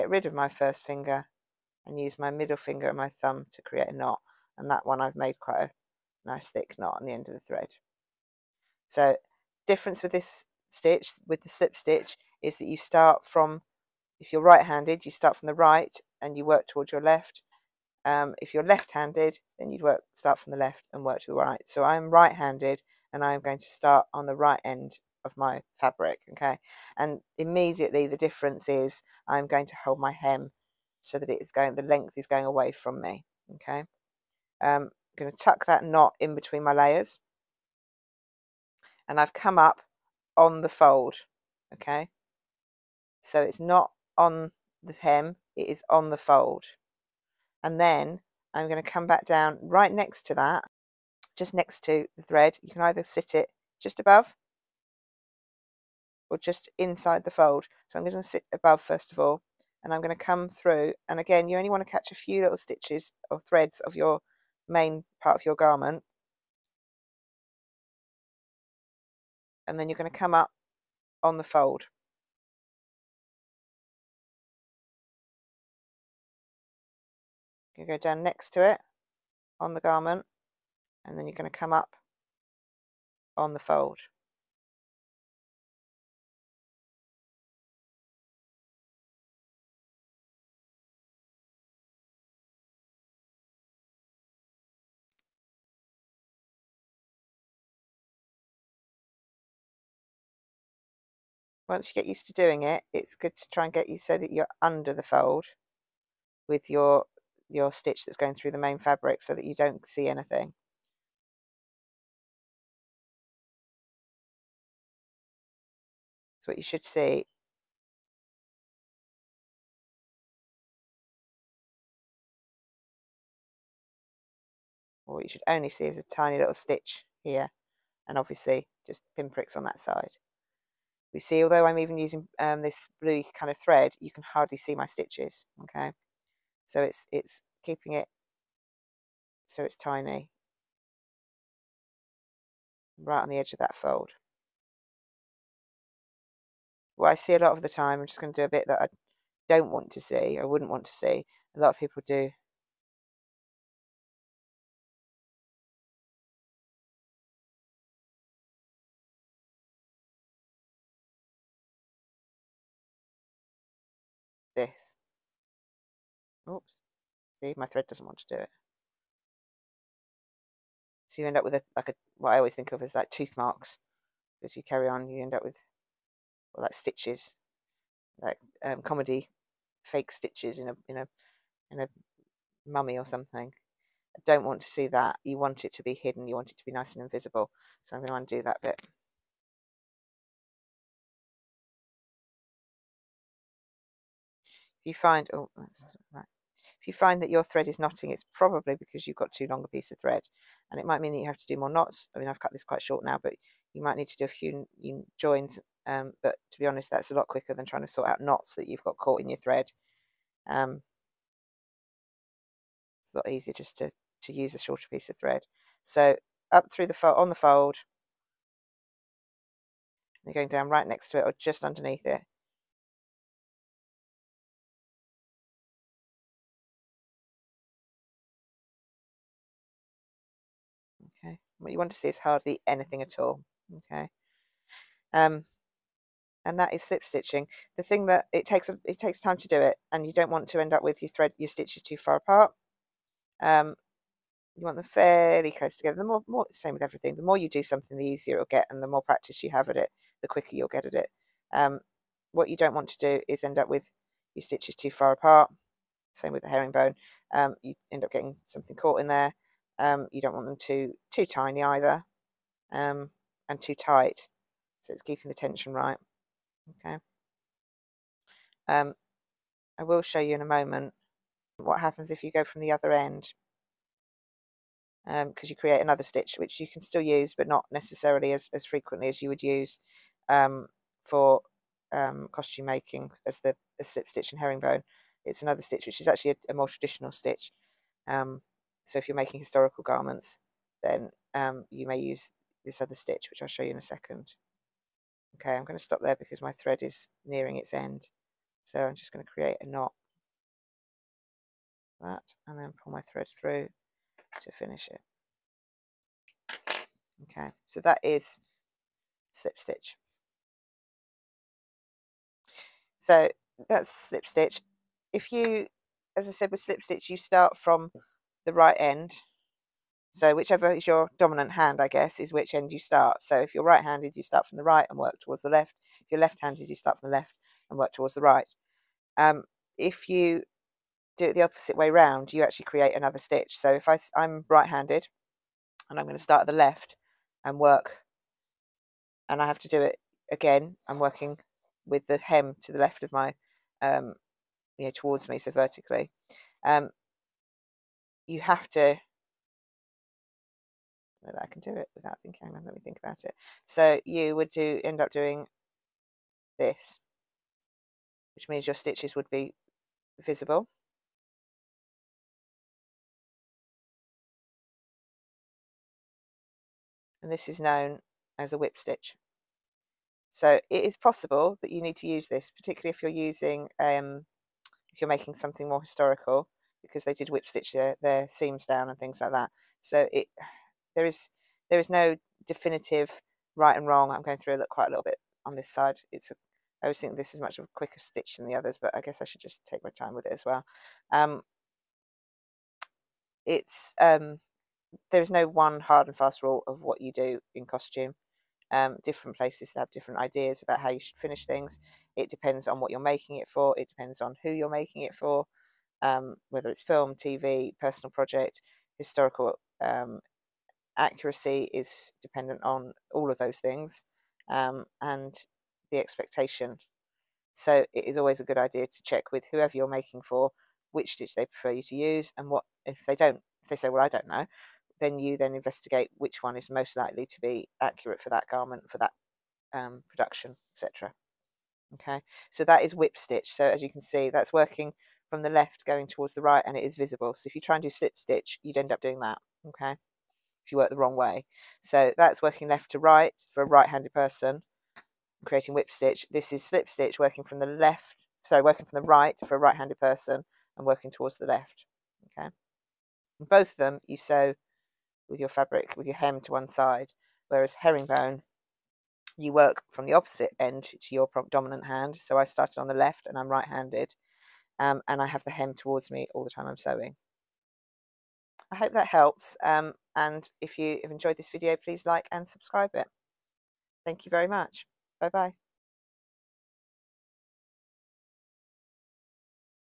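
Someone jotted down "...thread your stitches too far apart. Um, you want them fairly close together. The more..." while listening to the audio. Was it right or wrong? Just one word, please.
right.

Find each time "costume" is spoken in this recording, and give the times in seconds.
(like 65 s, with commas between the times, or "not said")
282 s, 397 s.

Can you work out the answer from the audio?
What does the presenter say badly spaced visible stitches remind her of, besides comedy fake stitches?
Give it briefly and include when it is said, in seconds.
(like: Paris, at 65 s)
Tooth marks, at 173 s.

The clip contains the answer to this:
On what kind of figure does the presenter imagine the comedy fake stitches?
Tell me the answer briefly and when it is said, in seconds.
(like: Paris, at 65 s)
A mummy, at 182 s.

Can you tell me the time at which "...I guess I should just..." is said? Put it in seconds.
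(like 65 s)
388 s.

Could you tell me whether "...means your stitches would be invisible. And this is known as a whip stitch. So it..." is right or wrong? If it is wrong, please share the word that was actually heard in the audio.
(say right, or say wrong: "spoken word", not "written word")
wrong: "visible", not "invisible".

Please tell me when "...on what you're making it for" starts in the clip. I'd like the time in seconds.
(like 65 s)
402 s.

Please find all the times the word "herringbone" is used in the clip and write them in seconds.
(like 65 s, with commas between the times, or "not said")
256 s, 284 s, 457 s.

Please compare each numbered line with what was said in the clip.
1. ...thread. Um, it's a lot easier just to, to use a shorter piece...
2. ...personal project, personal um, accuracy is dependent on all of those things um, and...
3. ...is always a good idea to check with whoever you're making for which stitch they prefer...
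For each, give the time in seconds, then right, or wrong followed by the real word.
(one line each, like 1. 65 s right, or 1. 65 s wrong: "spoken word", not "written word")
1. 209 s right
2. 407 s wrong: "historical", not "personal"
3. 418 s right.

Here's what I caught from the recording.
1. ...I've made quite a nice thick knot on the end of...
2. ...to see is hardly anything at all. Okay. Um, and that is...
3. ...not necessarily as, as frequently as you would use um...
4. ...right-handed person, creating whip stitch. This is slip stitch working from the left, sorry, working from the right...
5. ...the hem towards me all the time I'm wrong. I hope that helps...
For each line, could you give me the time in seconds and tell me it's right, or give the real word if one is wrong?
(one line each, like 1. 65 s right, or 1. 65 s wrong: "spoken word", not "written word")
1. 5 s right
2. 231 s right
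3. 277 s right
4. 443 s right
5. 465 s wrong: "sewing", not "wrong".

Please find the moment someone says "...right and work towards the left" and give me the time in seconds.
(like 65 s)
324 s.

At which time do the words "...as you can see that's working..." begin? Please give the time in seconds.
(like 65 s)
433 s.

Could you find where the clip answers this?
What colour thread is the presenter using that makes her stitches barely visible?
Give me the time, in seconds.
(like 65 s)
133 s.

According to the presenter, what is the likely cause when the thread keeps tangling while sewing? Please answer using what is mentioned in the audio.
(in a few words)
Too long a piece of thread.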